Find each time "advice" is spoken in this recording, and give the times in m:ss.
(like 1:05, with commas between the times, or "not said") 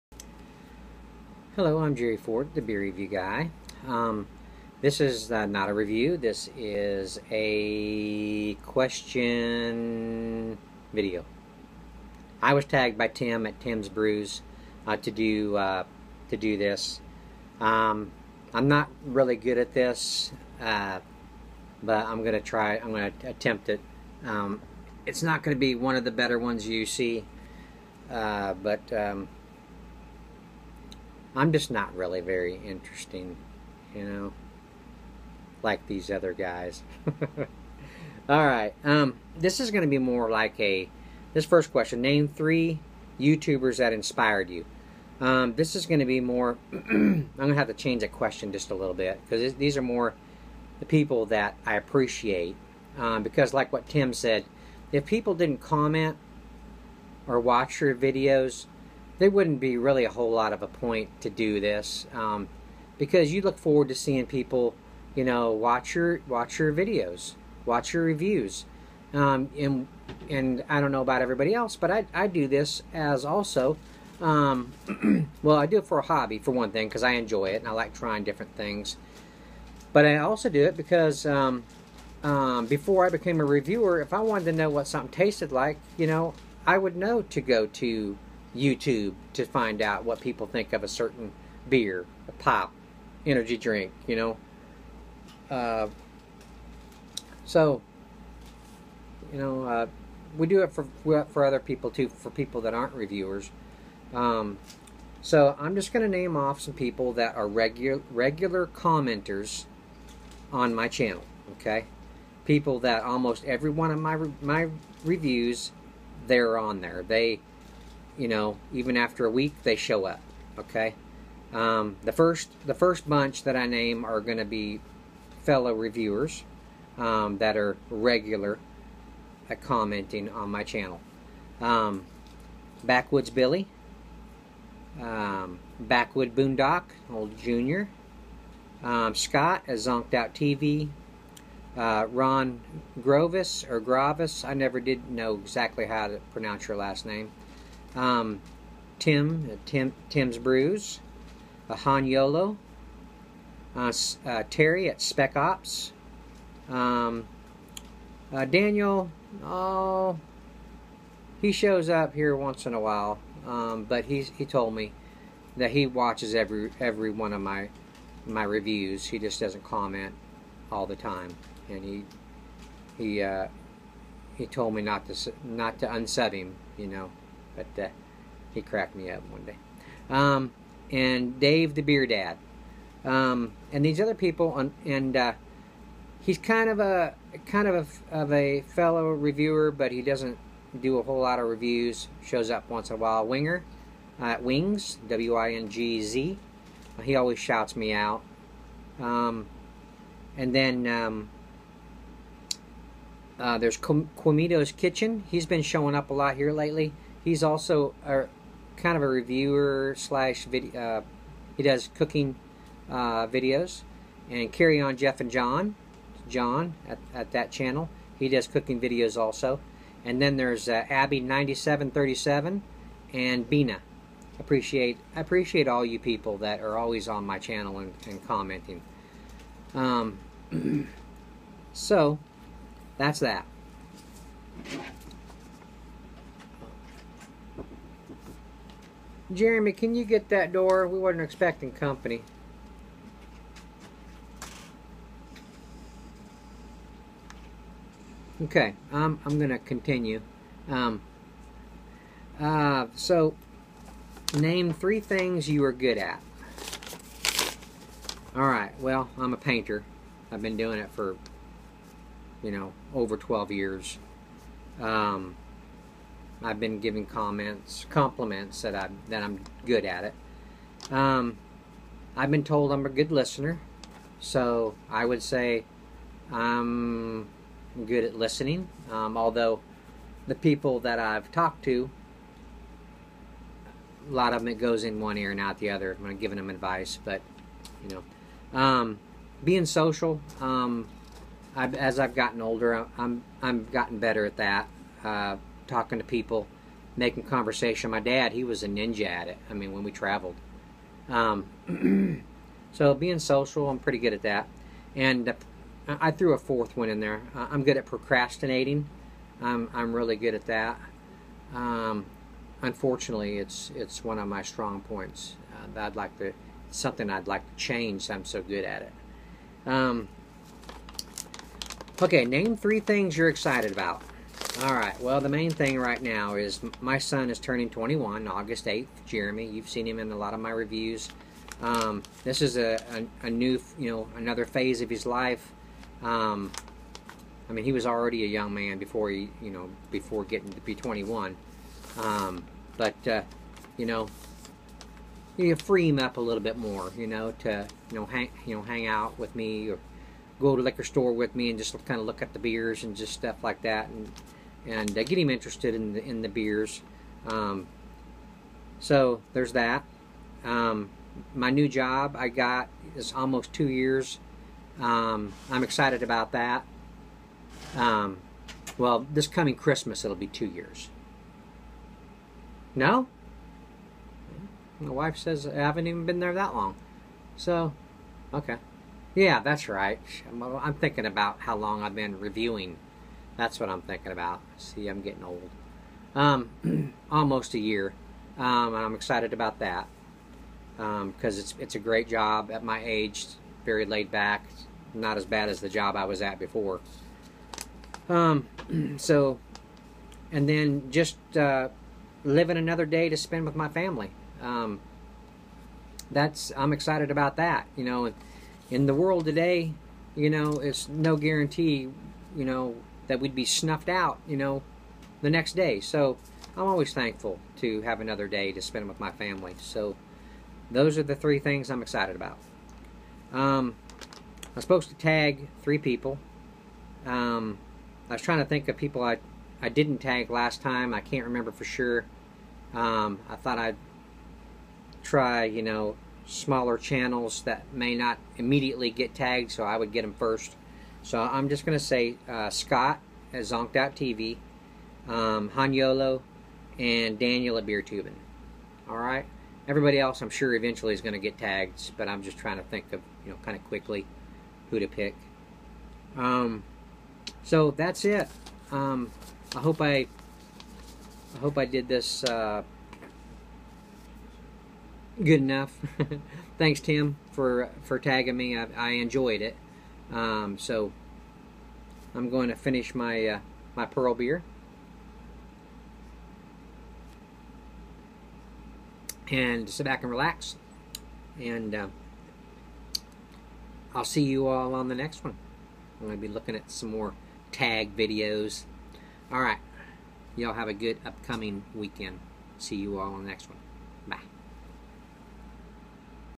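4:46.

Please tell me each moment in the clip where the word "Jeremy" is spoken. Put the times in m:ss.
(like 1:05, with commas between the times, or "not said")
3:59, 5:29.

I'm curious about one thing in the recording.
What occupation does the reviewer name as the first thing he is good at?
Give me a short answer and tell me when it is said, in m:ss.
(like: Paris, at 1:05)
Painter, at 4:19.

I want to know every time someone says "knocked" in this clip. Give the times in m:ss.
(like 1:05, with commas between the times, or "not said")
not said.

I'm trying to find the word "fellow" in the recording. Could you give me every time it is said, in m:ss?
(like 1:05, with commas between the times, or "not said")
2:05, 3:08.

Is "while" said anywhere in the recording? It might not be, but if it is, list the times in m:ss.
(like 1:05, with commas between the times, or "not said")
2:42, 3:12.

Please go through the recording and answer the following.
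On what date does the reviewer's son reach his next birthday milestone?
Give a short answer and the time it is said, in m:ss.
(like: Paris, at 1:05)
August 8th, at 5:28.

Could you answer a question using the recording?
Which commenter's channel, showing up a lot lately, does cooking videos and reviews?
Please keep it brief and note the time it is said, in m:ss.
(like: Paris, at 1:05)
Quimito's Kitchen, at 3:23.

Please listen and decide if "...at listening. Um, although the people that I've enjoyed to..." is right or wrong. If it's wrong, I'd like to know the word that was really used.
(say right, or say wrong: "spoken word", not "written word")
wrong: "talked", not "enjoyed".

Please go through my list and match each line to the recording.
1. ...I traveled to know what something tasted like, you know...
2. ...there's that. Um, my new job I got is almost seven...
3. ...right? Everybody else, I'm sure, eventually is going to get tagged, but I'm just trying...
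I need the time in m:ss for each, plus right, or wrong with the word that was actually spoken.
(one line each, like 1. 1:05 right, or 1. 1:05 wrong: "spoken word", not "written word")
1. 1:24 wrong: "wanted", not "traveled"
2. 5:59 wrong: "two", not "seven"
3. 7:28 right.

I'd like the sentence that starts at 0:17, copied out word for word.
Um, I'm not really good at this, uh, but I'm gonna try.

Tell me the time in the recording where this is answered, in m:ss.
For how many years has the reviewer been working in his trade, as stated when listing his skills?
4:22.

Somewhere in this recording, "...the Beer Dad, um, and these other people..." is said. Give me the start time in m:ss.
3:01.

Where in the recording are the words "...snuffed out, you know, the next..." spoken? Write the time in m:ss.
6:53.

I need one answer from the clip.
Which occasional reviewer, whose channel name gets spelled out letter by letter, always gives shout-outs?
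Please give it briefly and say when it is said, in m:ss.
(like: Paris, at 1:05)
Wings, at 3:14.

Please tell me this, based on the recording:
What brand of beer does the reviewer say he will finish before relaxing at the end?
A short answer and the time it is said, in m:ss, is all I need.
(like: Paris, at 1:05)
Pearl, at 7:53.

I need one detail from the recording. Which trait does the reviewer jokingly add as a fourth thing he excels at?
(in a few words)
Procrastinating.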